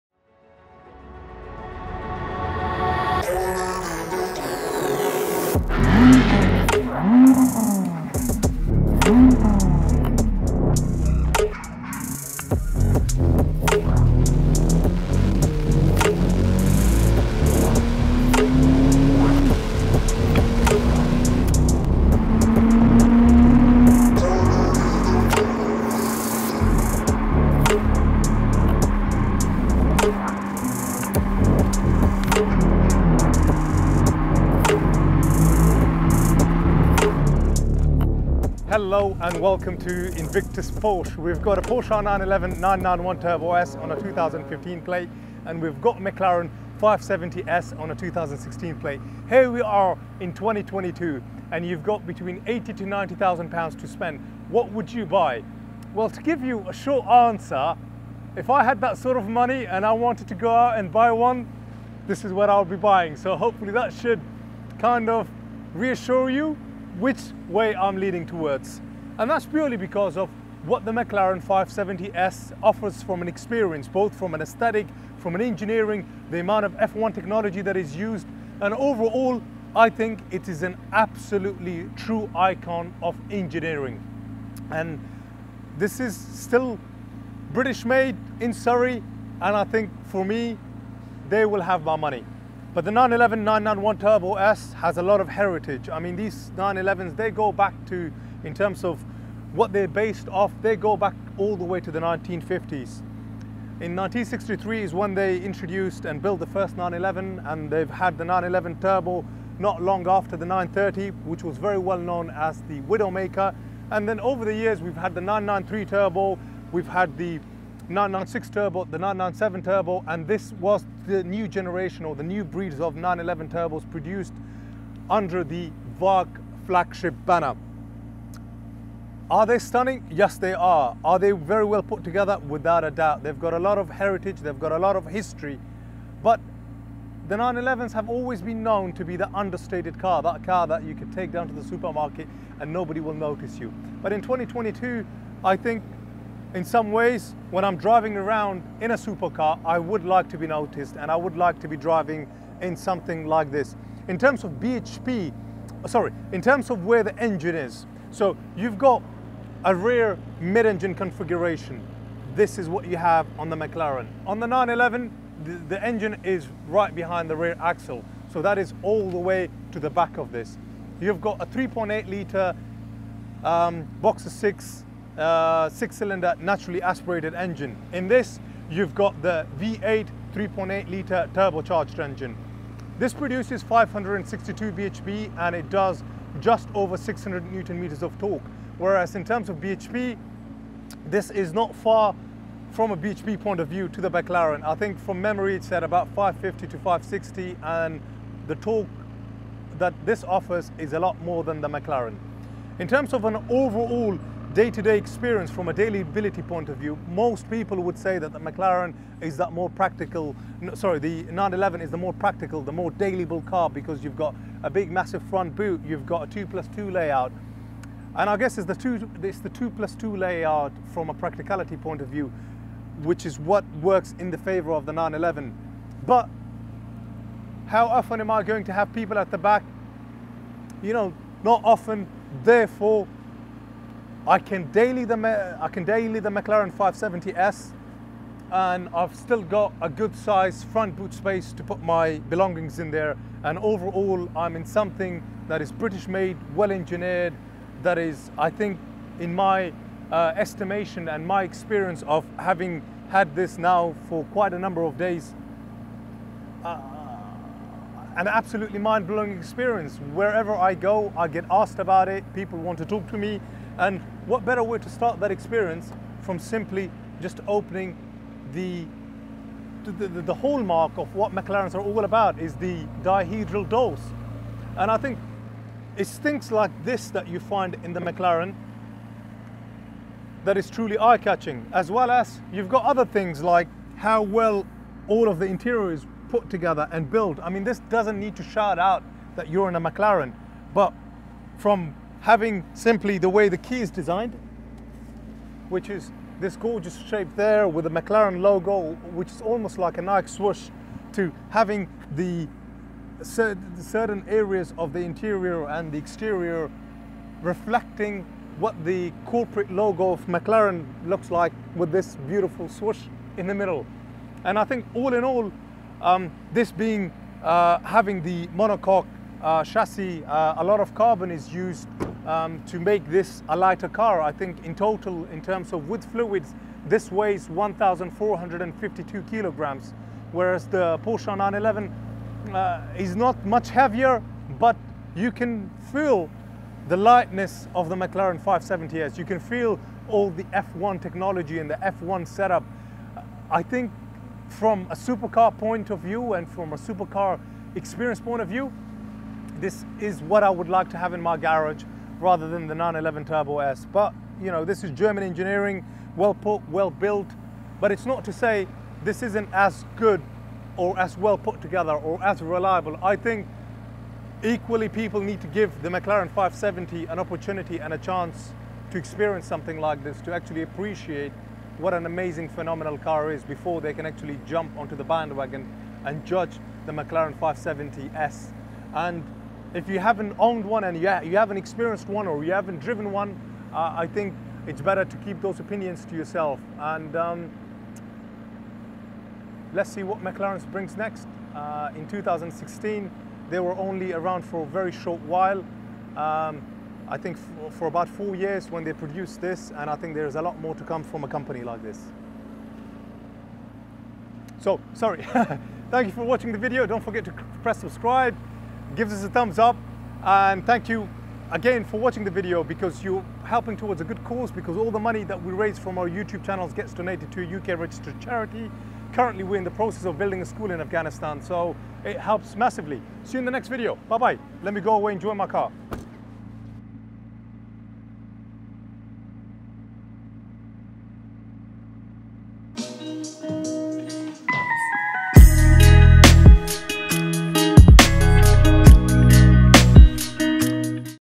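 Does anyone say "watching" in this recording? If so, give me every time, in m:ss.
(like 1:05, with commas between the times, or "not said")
6:46, 6:51.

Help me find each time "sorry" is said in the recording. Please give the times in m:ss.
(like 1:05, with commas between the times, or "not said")
2:35, 3:30, 6:44.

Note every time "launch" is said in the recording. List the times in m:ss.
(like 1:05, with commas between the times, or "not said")
not said.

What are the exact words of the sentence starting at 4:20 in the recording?
Wherever I go, I get asked about it.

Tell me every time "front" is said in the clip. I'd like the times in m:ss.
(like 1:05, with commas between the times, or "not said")
3:35, 4:00.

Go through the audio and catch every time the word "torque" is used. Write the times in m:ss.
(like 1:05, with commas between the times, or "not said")
3:08, 3:18.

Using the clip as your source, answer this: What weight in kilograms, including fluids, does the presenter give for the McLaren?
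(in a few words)
1,452 kilograms.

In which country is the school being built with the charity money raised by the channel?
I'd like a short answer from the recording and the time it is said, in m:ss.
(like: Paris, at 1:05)
Afghanistan, at 7:00.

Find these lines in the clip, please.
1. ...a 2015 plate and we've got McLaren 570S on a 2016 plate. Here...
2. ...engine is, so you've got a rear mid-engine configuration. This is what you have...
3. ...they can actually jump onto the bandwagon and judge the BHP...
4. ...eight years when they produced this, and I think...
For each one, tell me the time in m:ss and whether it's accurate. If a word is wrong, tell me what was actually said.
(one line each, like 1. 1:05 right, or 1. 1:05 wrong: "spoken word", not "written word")
1. 0:43 right
2. 2:37 right
3. 6:13 wrong: "McLaren", not "BHP"
4. 6:38 wrong: "four", not "eight".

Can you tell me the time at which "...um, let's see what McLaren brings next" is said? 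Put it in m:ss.
6:27.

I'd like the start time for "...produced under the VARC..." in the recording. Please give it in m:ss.
2:03.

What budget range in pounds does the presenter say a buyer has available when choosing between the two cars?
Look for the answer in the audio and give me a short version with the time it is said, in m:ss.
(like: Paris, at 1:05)
80 to 90,000 pounds, at 0:52.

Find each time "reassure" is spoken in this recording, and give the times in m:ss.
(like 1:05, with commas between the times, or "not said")
1:05.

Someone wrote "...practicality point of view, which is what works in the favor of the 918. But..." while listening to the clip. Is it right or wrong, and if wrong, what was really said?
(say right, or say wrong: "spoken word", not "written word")
wrong: "911", not "918".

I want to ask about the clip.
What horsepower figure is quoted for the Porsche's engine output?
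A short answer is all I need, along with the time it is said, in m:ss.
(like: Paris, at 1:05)
562 bhp, at 3:03.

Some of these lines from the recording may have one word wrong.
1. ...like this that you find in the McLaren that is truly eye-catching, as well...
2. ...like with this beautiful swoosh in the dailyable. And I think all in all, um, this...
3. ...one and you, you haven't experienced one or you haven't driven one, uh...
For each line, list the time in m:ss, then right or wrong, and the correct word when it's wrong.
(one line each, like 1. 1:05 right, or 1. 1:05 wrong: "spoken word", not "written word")
1. 4:36 right
2. 5:11 wrong: "middle", not "dailyable"
3. 6:20 right.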